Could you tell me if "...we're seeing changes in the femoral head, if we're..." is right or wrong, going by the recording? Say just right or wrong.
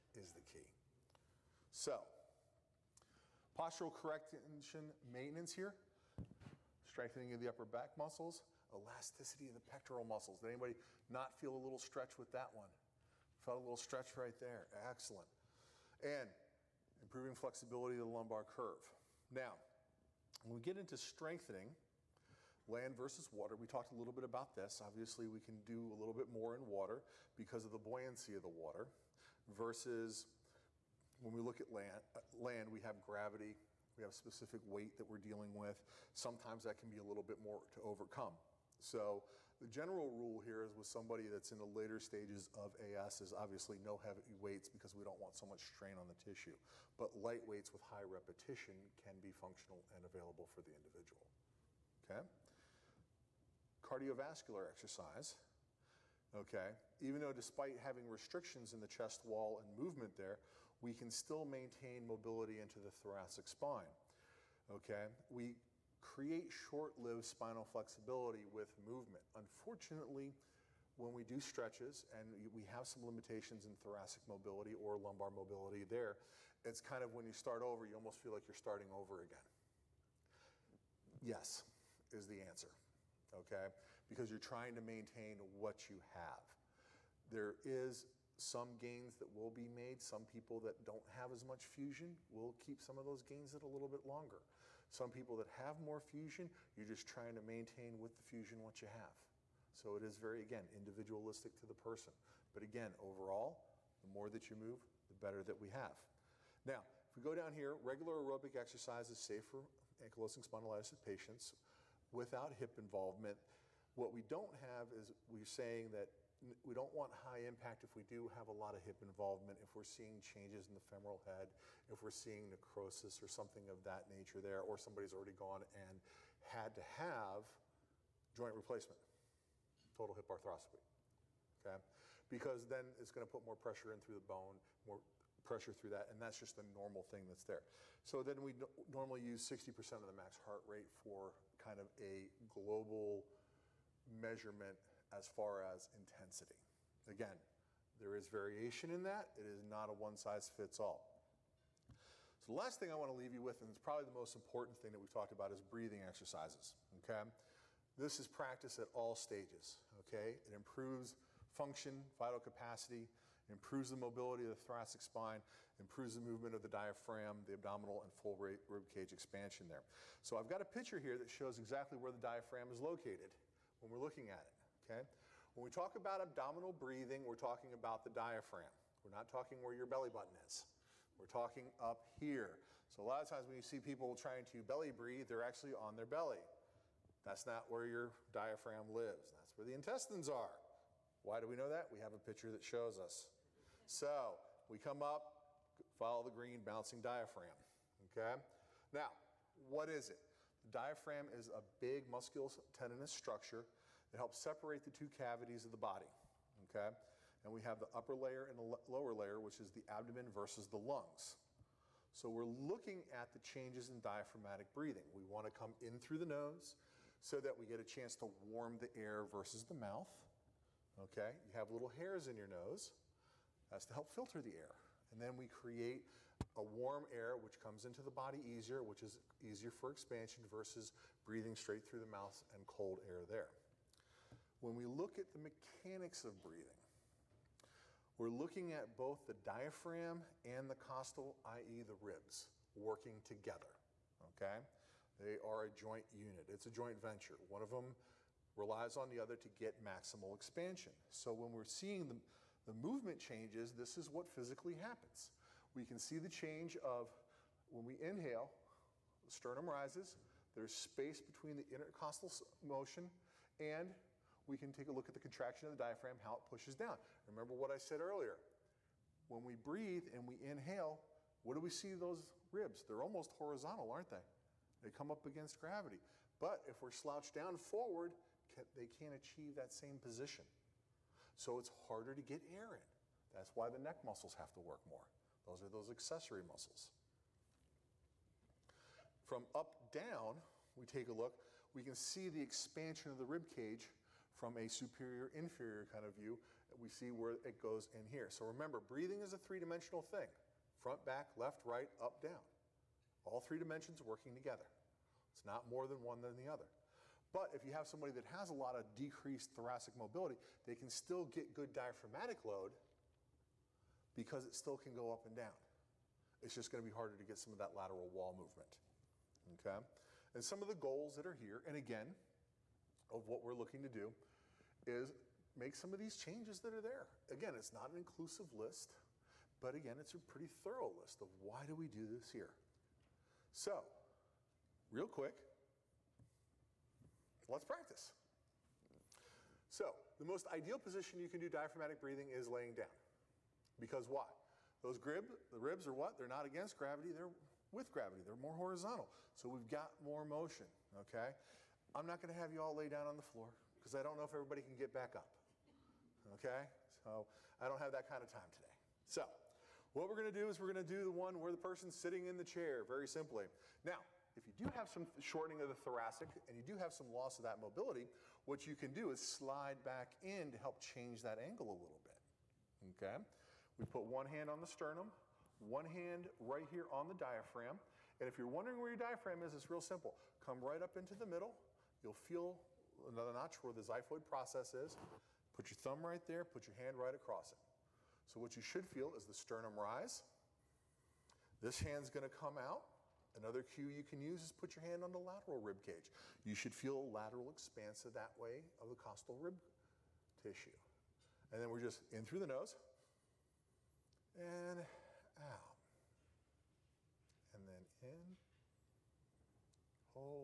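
right.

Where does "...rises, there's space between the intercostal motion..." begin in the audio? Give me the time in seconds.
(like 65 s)
259 s.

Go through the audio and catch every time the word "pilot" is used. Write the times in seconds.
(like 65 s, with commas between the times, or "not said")
not said.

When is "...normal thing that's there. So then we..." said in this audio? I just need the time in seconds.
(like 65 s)
136 s.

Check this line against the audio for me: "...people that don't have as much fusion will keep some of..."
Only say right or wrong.
right.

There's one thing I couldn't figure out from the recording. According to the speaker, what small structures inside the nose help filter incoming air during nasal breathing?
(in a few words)
Little hairs.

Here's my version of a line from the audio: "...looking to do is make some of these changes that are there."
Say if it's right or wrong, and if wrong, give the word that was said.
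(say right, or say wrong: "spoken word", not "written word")
right.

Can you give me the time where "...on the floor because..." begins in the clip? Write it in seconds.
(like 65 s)
353 s.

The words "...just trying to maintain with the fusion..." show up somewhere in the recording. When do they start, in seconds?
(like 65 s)
96 s.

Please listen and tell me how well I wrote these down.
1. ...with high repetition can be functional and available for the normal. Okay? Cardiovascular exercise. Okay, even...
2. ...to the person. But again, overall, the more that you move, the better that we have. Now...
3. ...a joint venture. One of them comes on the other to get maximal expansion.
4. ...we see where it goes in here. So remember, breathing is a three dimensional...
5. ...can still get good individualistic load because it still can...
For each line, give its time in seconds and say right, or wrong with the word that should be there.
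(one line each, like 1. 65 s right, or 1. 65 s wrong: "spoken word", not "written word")
1. 47 s wrong: "individual", not "normal"
2. 101 s right
3. 246 s wrong: "relies", not "comes"
4. 296 s right
5. 310 s wrong: "diaphragmatic", not "individualistic".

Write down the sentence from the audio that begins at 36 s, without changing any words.
Sometimes that can be a little bit more to overcome.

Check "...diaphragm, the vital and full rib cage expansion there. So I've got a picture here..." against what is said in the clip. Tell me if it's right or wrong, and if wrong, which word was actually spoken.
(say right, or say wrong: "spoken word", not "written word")
wrong: "abdominal", not "vital".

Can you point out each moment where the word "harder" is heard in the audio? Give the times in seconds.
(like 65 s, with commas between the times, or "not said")
281 s, 316 s.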